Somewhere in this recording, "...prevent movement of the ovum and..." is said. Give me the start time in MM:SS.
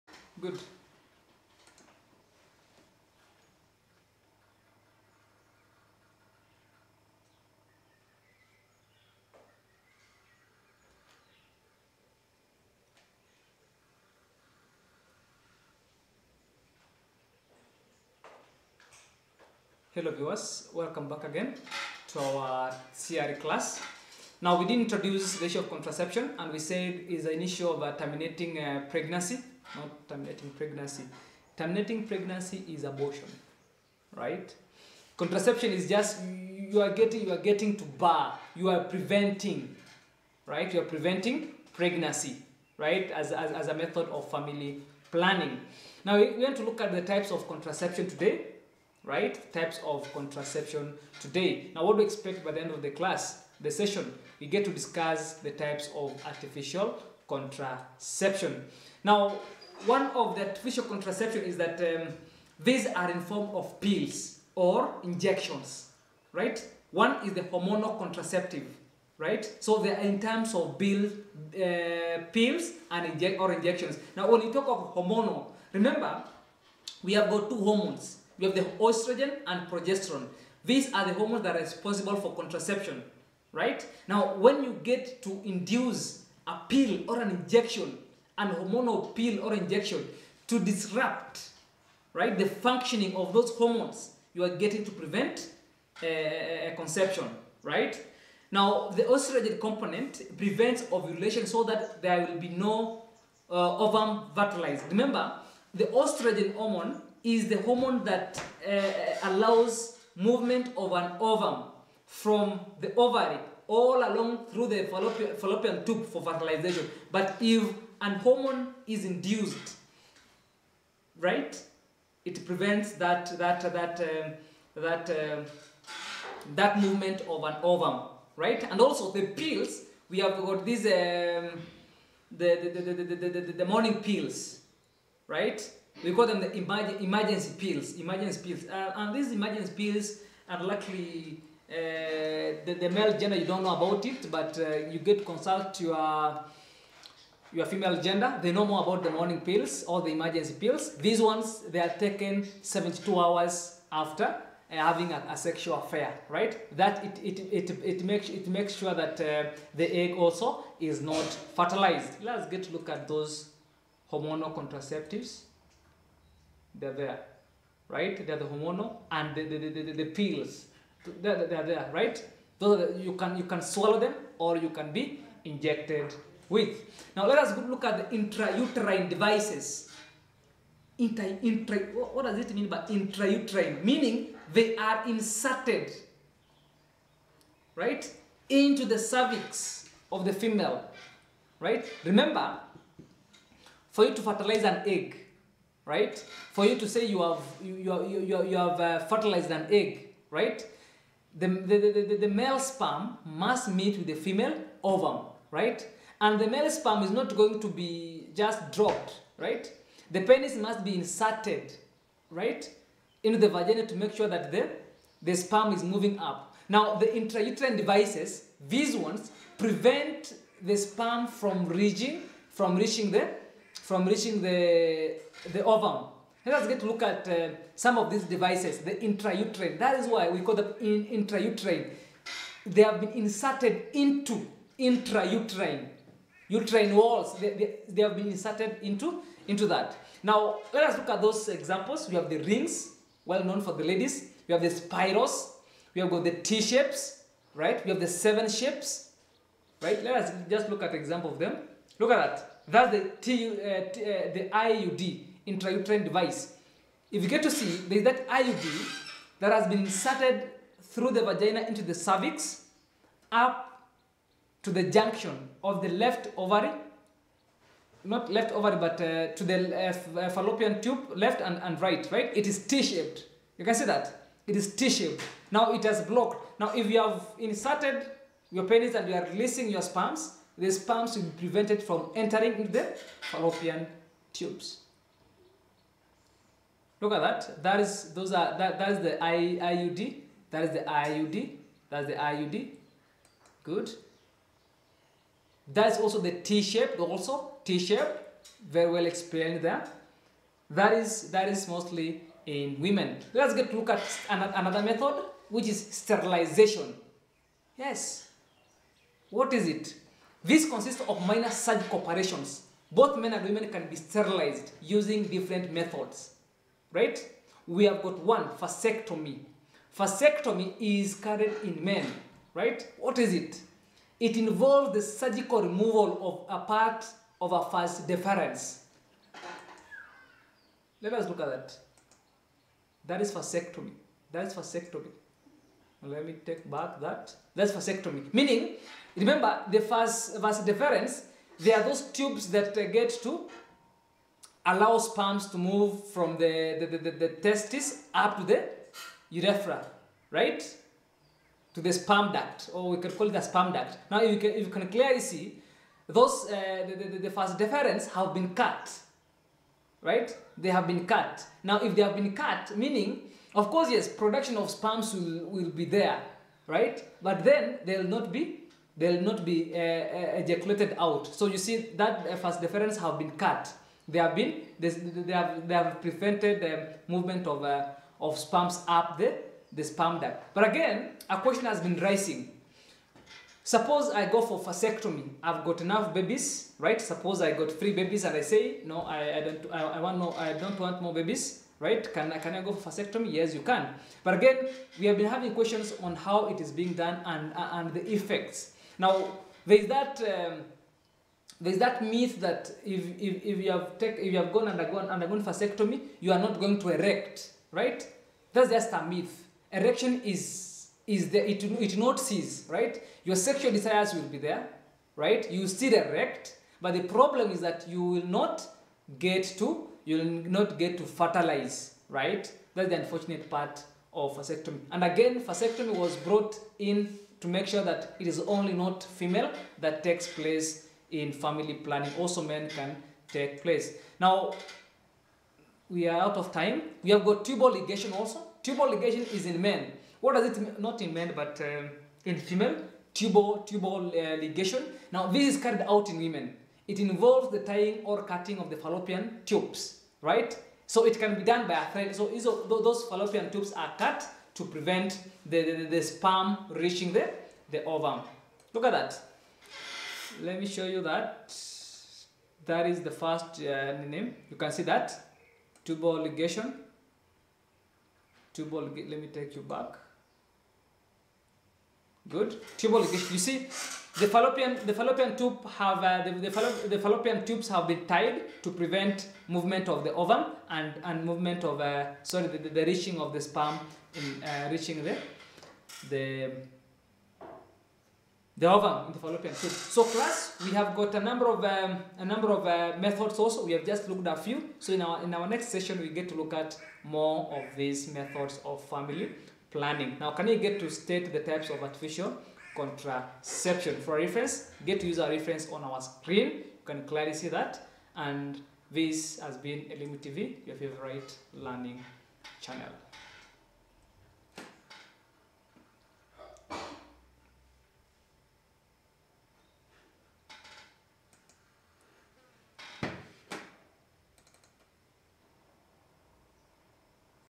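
07:58.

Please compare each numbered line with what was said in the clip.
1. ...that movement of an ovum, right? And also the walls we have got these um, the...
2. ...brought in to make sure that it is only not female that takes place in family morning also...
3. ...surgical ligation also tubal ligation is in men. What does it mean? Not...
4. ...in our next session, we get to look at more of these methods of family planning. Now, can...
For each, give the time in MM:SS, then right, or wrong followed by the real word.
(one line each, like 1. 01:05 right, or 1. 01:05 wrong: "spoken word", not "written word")
1. 02:06 wrong: "pills", not "walls"
2. 07:06 wrong: "planning", not "morning"
3. 07:17 wrong: "tubal", not "surgical"
4. 08:15 right.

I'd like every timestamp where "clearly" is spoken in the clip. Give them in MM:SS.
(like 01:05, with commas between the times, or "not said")
05:54, 08:27.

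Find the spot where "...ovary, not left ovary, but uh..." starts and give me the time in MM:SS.
04:26.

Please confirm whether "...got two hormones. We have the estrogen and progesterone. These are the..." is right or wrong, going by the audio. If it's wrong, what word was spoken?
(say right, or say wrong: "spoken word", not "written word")
right.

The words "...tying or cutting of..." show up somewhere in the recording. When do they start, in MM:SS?
07:27.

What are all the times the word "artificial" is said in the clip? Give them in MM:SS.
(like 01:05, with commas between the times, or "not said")
00:56, 01:00, 08:21.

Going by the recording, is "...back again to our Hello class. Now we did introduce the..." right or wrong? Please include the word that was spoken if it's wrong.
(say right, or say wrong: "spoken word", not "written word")
wrong: "CRE", not "Hello".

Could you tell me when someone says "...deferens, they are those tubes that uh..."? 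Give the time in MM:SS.
05:40.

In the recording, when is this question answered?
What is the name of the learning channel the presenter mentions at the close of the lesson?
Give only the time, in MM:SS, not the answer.
08:29.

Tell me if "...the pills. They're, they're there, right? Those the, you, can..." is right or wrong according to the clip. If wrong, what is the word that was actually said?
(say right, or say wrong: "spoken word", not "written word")
right.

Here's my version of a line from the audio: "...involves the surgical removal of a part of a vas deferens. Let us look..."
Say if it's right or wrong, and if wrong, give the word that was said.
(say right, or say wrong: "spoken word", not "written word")
right.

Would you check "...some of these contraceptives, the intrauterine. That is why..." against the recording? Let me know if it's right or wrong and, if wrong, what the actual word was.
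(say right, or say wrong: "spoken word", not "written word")
wrong: "devices", not "contraceptives".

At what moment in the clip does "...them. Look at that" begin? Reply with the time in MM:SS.
04:11.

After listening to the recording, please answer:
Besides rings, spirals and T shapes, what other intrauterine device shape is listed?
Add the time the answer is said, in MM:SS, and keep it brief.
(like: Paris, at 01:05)
Seven shapes, at 04:08.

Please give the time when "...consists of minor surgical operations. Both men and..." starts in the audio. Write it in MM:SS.
05:10.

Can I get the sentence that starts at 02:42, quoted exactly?
Let's get a look at those hormonal contraceptives.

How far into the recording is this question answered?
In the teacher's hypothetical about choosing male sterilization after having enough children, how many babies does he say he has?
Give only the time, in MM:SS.
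06:27.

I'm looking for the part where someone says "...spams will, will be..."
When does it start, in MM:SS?
06:04.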